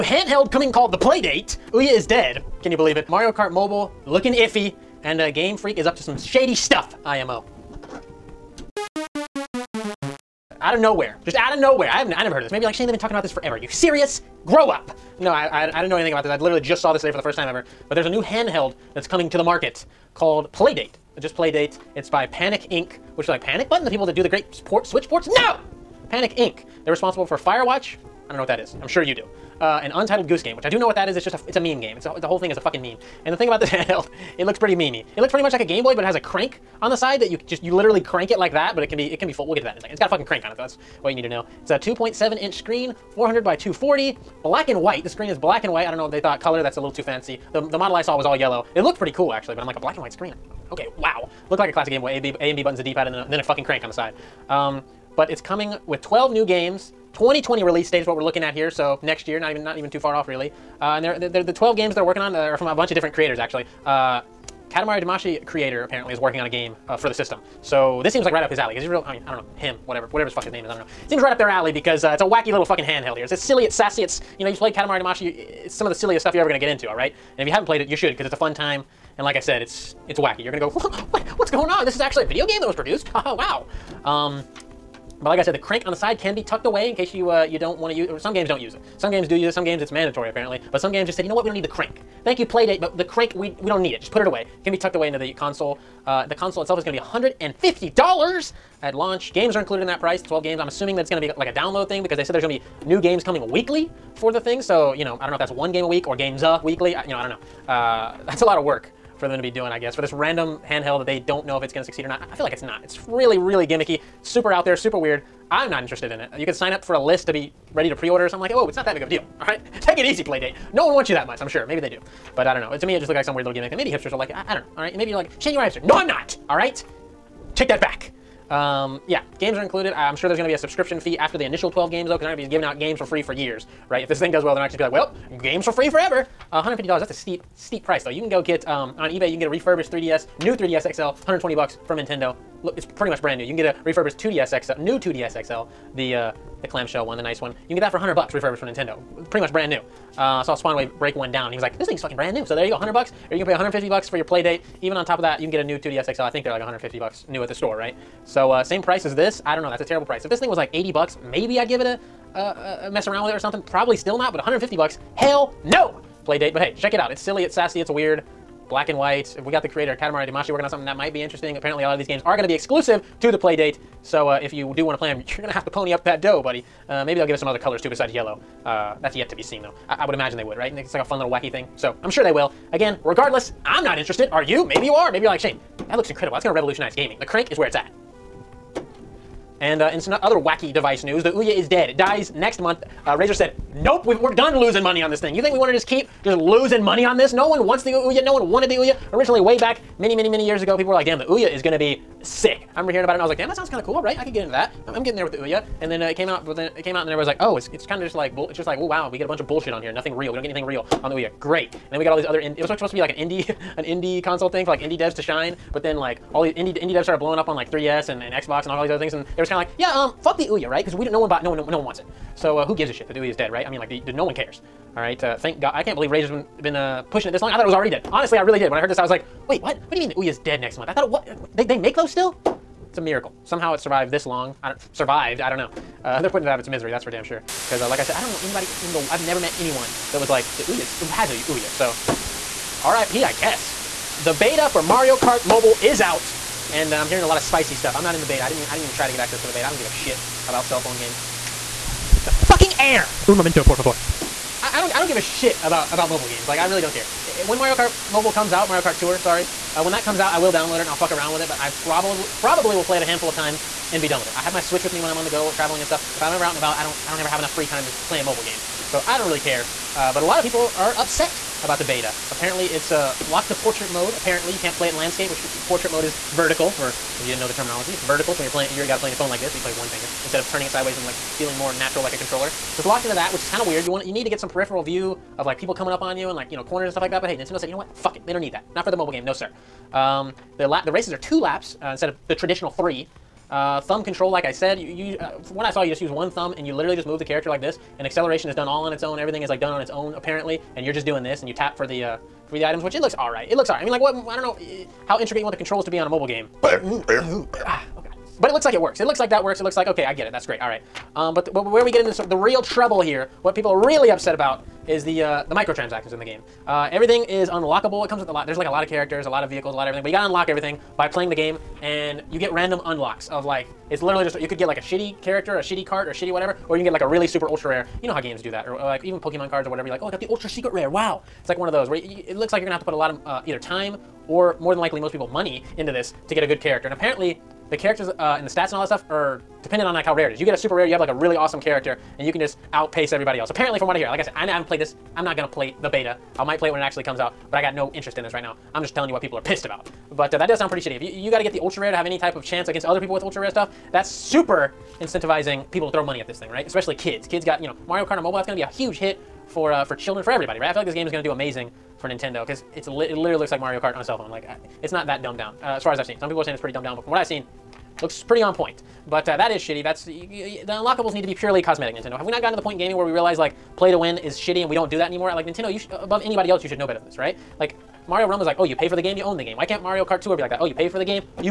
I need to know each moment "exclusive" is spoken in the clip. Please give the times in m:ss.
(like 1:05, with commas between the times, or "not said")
2:52.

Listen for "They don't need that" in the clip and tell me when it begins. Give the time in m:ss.
4:48.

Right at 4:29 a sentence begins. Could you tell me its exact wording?
Uh, but a lot of people are upset about the beta.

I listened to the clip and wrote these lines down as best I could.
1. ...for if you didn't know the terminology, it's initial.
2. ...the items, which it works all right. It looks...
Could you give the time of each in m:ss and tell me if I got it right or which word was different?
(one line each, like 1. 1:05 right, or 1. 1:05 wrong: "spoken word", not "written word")
1. 4:36 wrong: "vertical", not "initial"
2. 5:02 wrong: "looks", not "works".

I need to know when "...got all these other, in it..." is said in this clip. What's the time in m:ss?
3:32.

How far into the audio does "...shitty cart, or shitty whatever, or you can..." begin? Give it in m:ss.
5:25.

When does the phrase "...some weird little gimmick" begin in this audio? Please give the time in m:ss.
2:03.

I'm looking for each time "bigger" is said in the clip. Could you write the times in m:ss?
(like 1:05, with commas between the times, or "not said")
not said.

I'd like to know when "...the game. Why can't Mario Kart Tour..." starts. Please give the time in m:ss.
6:19.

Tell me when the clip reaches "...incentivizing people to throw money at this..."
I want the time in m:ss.
5:54.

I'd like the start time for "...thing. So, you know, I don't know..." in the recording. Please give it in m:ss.
1:44.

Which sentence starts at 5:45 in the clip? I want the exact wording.
I'm not gonna play the beta.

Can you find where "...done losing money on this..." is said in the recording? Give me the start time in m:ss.
3:14.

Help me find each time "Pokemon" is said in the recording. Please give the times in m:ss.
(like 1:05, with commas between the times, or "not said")
5:29.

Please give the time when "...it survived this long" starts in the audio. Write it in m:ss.
3:53.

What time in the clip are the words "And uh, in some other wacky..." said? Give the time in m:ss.
3:09.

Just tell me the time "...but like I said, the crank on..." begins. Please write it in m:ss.
1:25.